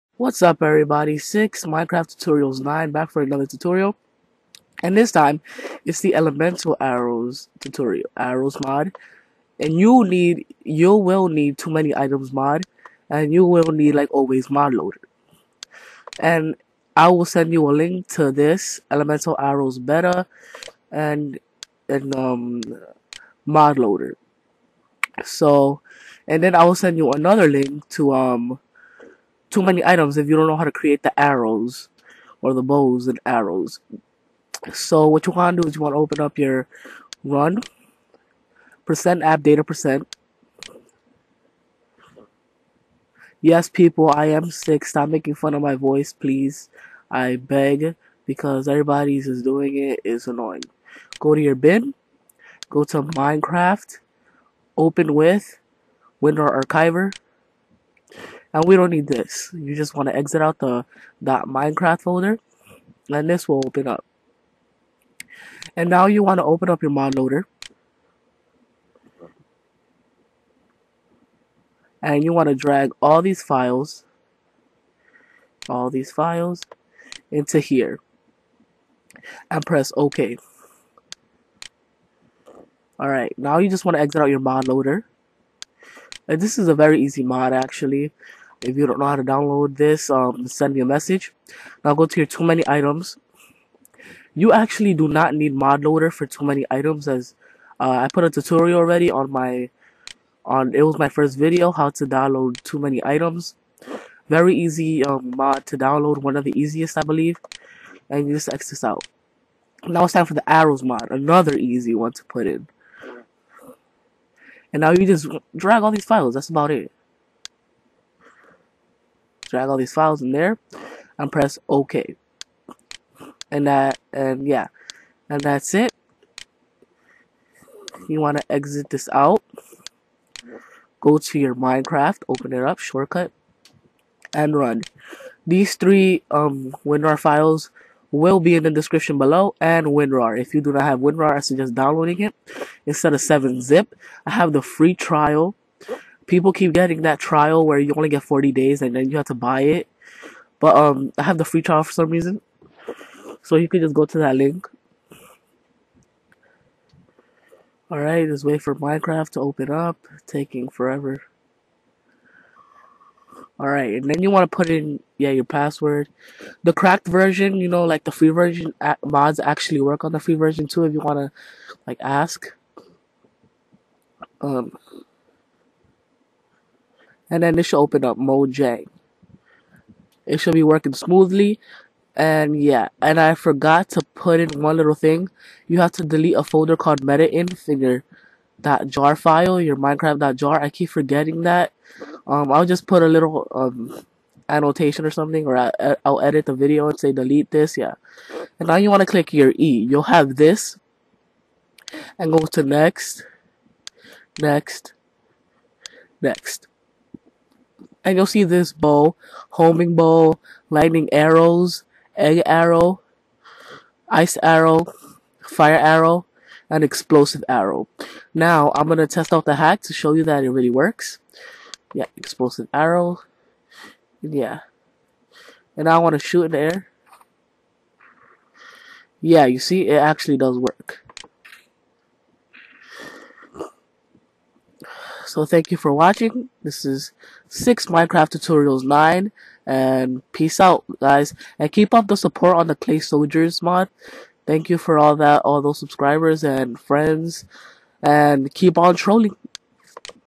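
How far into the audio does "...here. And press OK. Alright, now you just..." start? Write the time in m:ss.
1:17.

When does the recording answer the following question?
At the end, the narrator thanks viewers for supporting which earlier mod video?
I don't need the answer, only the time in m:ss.
4:02.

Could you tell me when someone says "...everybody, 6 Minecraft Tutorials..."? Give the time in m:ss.
0:00.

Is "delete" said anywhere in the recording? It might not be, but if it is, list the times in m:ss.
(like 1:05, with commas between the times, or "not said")
3:06, 3:17.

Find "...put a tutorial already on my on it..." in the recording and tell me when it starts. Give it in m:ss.
1:38.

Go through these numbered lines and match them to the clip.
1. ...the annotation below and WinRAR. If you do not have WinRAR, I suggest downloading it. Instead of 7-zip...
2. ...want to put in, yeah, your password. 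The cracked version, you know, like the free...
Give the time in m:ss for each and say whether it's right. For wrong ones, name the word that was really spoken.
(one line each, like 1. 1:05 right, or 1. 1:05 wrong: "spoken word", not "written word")
1. 2:18 wrong: "description", not "annotation"
2. 2:44 right.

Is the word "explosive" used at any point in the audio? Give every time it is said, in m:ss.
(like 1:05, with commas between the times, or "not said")
3:36, 3:42.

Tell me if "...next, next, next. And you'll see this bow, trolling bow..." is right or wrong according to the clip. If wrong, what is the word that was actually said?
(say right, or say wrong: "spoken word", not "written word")
wrong: "homing", not "trolling".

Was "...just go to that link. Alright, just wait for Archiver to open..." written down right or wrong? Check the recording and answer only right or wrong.
wrong.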